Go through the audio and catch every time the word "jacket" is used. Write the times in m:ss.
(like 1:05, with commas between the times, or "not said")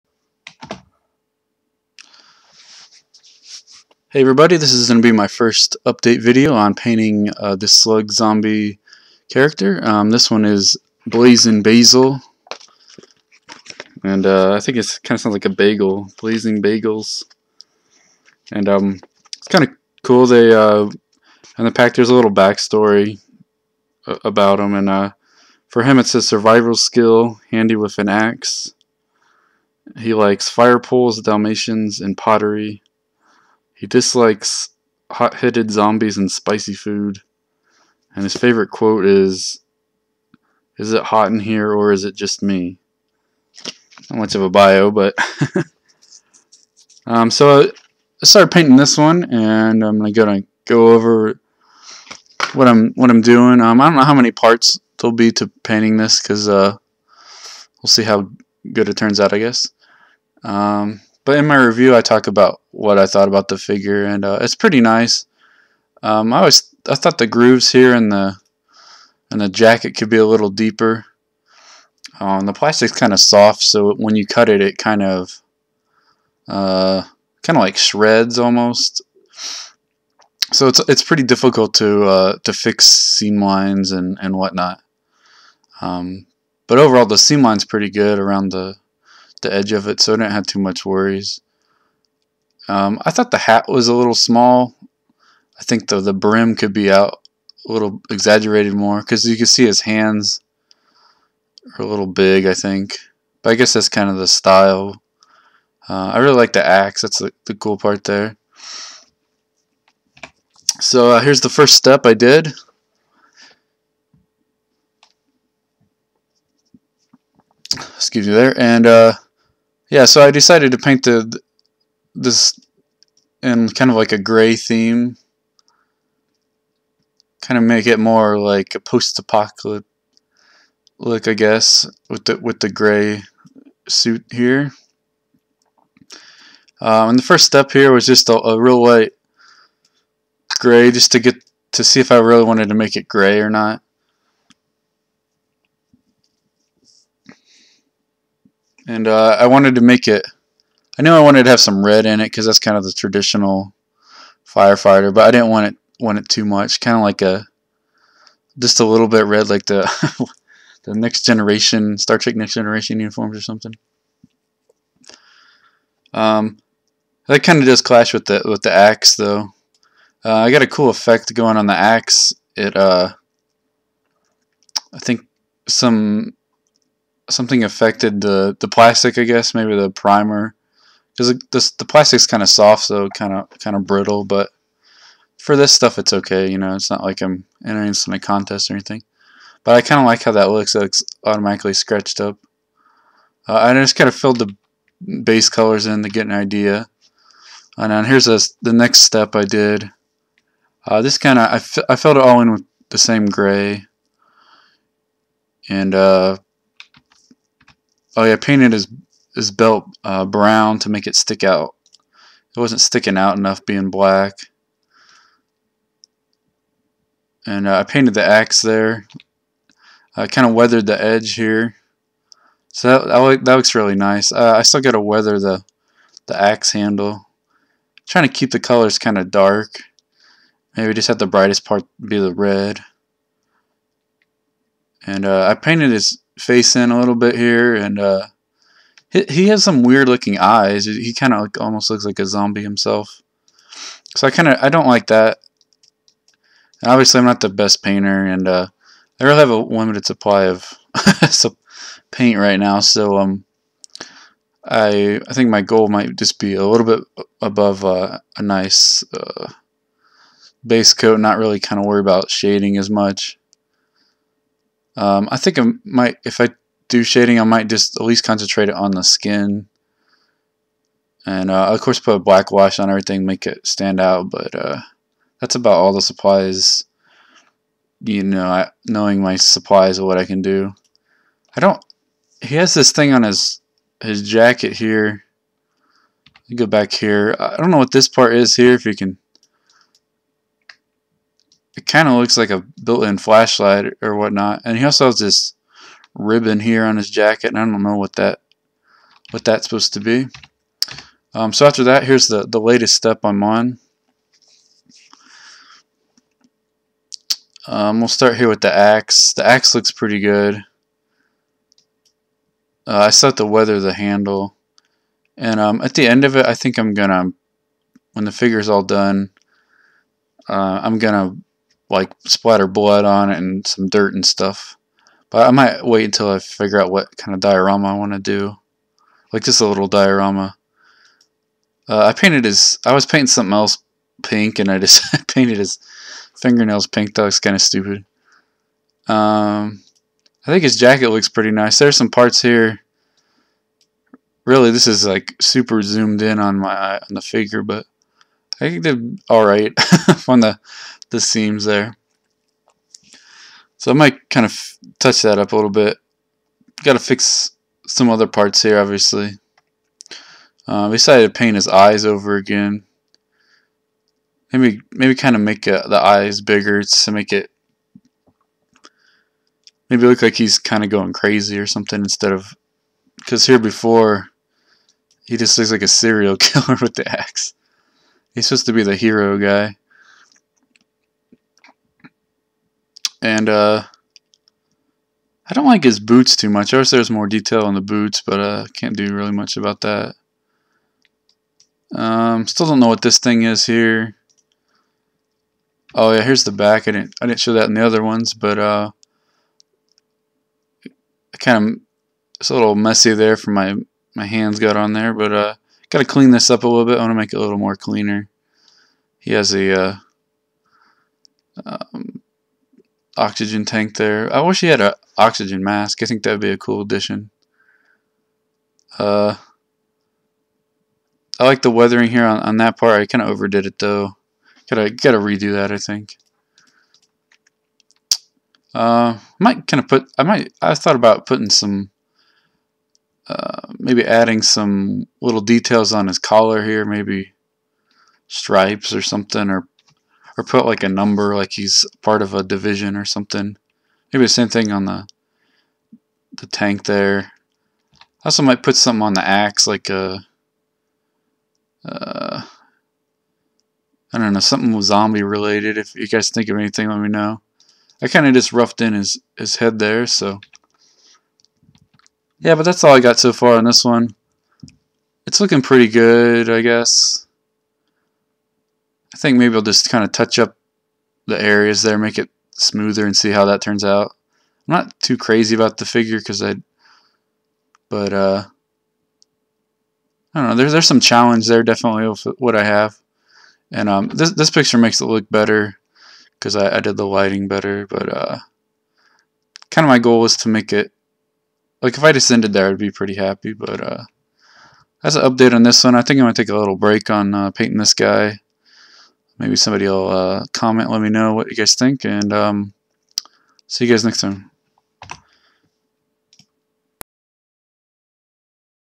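1:09, 4:44, 4:57, 5:40.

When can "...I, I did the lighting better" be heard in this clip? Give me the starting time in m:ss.
8:06.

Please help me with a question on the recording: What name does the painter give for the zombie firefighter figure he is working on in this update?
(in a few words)
Blazing Basel.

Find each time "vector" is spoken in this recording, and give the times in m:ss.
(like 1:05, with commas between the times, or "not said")
not said.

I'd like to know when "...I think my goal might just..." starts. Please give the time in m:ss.
4:15.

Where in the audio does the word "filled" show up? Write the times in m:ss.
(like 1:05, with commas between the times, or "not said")
3:14, 3:21.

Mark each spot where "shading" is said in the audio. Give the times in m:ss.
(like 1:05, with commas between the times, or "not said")
4:22, 4:27.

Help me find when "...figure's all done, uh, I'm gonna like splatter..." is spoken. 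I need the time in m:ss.
5:18.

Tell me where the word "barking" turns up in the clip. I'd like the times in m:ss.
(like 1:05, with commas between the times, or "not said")
not said.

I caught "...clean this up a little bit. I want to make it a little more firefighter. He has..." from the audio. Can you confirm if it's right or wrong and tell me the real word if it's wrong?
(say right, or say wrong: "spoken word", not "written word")
wrong: "cleaner", not "firefighter".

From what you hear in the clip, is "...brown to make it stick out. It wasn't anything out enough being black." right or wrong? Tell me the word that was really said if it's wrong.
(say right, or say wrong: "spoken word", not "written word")
wrong: "sticking", not "anything".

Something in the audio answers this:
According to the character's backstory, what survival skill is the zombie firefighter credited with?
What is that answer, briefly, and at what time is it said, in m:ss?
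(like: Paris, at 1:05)
handy with an axe, at 0:27.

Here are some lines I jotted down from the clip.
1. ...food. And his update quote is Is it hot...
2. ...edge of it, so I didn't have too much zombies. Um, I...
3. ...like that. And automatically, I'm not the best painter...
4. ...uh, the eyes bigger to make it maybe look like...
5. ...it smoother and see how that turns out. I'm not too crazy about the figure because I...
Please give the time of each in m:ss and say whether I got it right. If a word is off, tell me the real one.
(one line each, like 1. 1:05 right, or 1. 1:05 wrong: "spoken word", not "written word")
1. 0:36 wrong: "favorite", not "update"
2. 1:29 wrong: "worries", not "zombies"
3. 4:04 wrong: "obviously", not "automatically"
4. 6:05 right
5. 7:52 right.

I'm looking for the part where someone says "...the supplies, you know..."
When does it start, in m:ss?
4:35.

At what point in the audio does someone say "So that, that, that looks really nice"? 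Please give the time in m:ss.
3:42.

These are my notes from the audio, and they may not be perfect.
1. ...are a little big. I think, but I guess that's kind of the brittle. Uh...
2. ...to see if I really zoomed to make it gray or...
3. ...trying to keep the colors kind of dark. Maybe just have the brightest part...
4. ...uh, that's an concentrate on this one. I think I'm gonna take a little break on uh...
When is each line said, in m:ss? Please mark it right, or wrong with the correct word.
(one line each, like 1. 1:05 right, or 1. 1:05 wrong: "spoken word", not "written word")
1. 1:41 wrong: "style", not "brittle"
2. 2:21 wrong: "wanted", not "zoomed"
3. 3:48 right
4. 8:13 wrong: "update", not "concentrate".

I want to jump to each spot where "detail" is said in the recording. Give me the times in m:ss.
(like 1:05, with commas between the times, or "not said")
6:27, 7:15.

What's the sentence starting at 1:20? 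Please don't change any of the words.
So it's it's pretty difficult to uh, to fix seam lines and and whatnot.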